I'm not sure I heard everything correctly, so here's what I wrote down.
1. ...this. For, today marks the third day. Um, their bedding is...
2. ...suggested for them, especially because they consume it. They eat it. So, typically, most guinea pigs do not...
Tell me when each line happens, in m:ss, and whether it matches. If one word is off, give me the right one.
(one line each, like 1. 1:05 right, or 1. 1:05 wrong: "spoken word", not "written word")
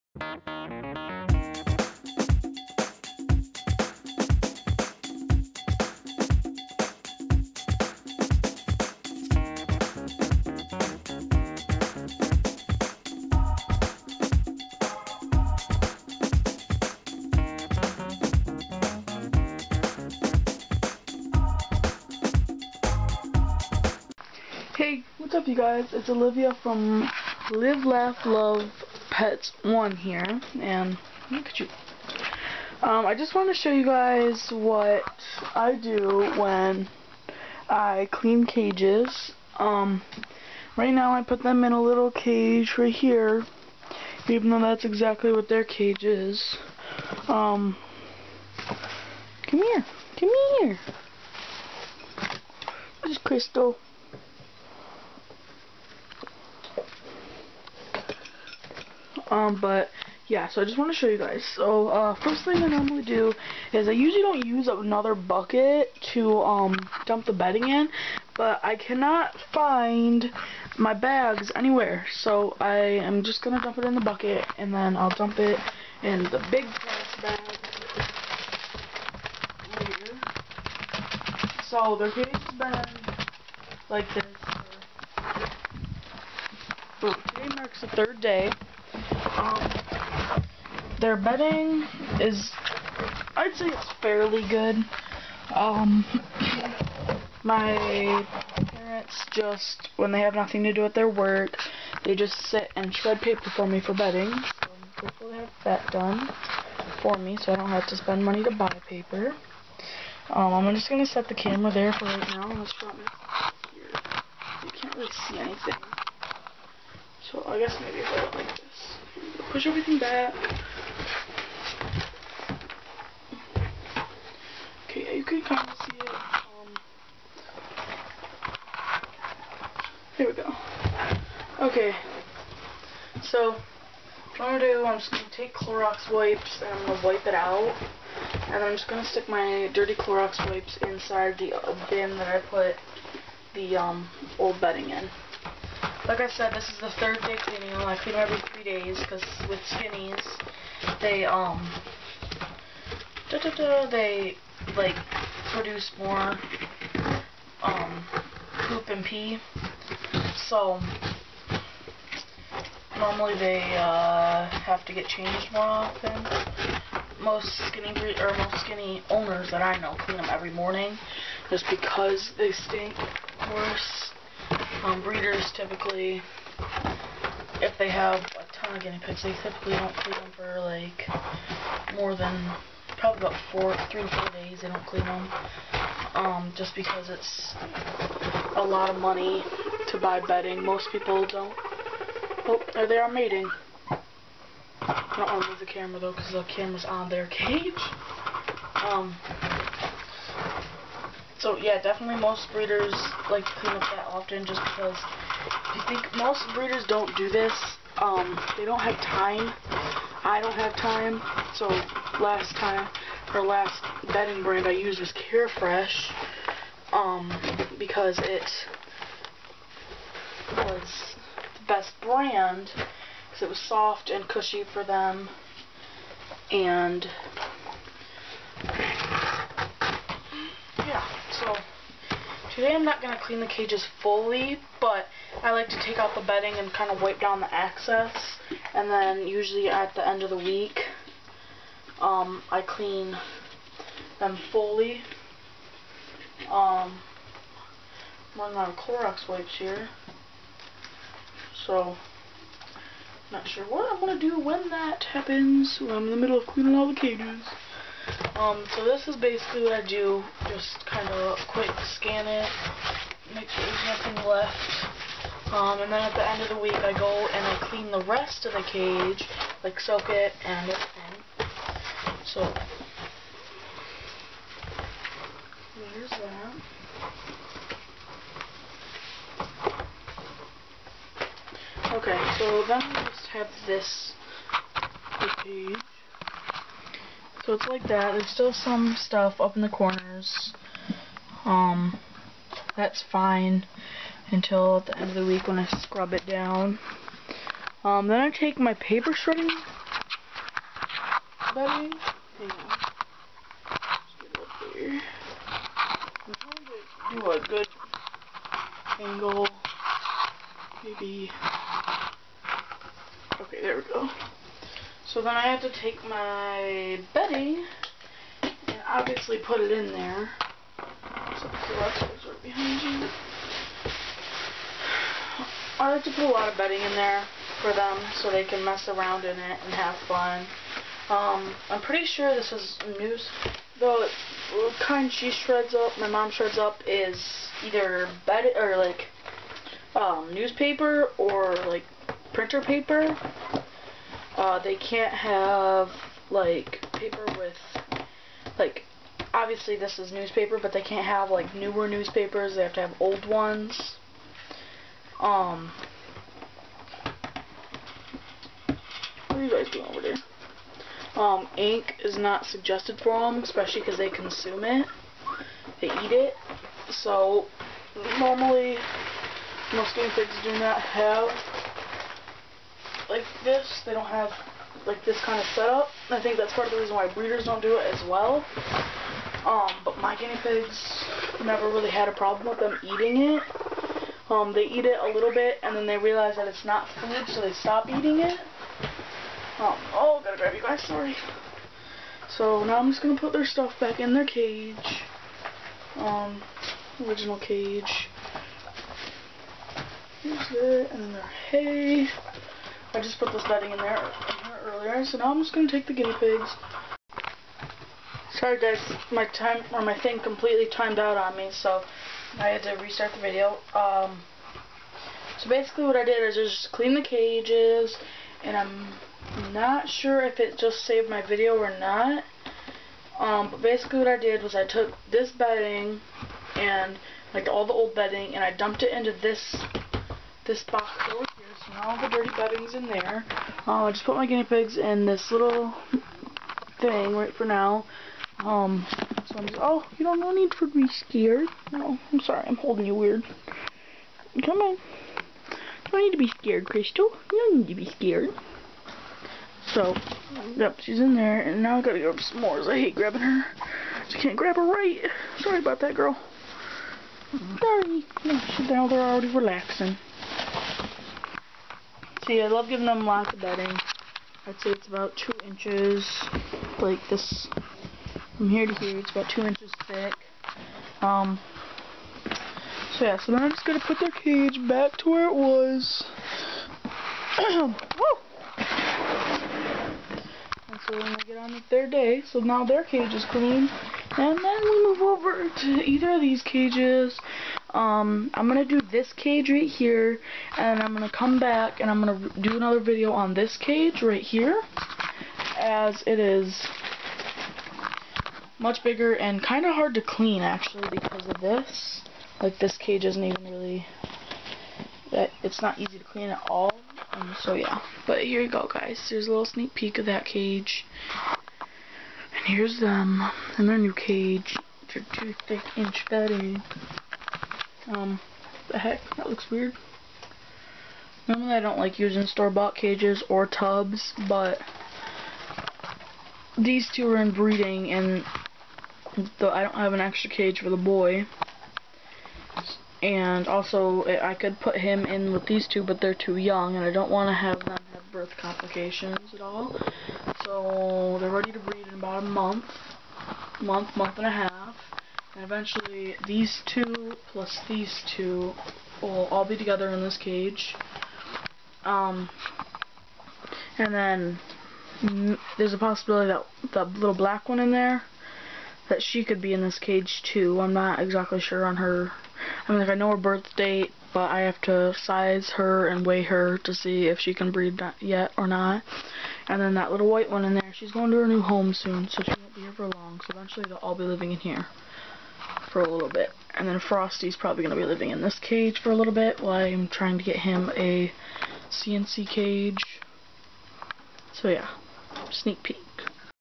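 1. 1:24 right
2. 6:02 wrong: "normally", not "typically".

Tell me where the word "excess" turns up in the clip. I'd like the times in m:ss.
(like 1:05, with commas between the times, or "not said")
3:57.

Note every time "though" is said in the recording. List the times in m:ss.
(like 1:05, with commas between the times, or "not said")
0:44, 3:15.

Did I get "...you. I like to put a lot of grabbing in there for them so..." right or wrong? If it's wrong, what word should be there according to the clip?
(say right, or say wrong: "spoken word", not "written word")
wrong: "bedding", not "grabbing".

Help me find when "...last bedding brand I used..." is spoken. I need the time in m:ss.
3:33.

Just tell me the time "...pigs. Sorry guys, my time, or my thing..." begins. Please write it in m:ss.
6:46.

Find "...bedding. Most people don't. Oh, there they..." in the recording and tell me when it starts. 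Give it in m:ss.
3:10.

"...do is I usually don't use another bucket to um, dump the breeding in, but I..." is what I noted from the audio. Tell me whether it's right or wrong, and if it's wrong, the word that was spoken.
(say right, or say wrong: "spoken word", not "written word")
wrong: "bedding", not "breeding".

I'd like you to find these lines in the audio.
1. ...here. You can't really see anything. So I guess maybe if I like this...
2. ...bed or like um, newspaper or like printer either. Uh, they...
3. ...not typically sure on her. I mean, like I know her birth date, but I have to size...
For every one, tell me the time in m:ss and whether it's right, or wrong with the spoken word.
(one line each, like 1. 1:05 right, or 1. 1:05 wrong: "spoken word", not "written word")
1. 1:53 right
2. 5:38 wrong: "paper", not "either"
3. 9:20 wrong: "exactly", not "typically".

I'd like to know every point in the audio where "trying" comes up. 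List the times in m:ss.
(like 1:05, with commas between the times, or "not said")
5:06, 9:39.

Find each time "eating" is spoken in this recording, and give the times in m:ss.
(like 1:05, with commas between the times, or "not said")
6:22, 6:27.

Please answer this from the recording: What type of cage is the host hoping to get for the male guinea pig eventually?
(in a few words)
CNC cage.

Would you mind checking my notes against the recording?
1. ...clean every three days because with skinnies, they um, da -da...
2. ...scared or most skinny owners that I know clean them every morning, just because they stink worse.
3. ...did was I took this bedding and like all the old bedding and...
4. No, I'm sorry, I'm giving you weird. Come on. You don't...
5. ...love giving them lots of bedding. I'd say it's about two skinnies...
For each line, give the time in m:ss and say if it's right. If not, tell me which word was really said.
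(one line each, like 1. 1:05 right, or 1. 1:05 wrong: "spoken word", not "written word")
1. 2:27 right
2. 2:47 wrong: "breed", not "scared"
3. 7:04 right
4. 7:21 wrong: "holding", not "giving"
5. 7:42 wrong: "inches", not "skinnies".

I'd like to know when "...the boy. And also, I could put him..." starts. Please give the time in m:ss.
8:50.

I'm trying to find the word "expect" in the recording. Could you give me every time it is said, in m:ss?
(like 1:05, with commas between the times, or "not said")
not said.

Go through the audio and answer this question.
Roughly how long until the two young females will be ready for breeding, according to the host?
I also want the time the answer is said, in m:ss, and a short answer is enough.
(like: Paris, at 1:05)
About a month, at 9:01.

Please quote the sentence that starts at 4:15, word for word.
I'm in the middle of cleaning all the cages.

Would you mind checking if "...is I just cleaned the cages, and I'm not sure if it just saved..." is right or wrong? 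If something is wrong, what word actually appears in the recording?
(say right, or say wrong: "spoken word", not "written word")
right.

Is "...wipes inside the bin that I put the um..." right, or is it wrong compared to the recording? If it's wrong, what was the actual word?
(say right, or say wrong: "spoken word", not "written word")
right.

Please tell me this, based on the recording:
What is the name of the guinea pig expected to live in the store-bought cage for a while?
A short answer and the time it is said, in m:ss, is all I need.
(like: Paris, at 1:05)
Frosty, at 9:36.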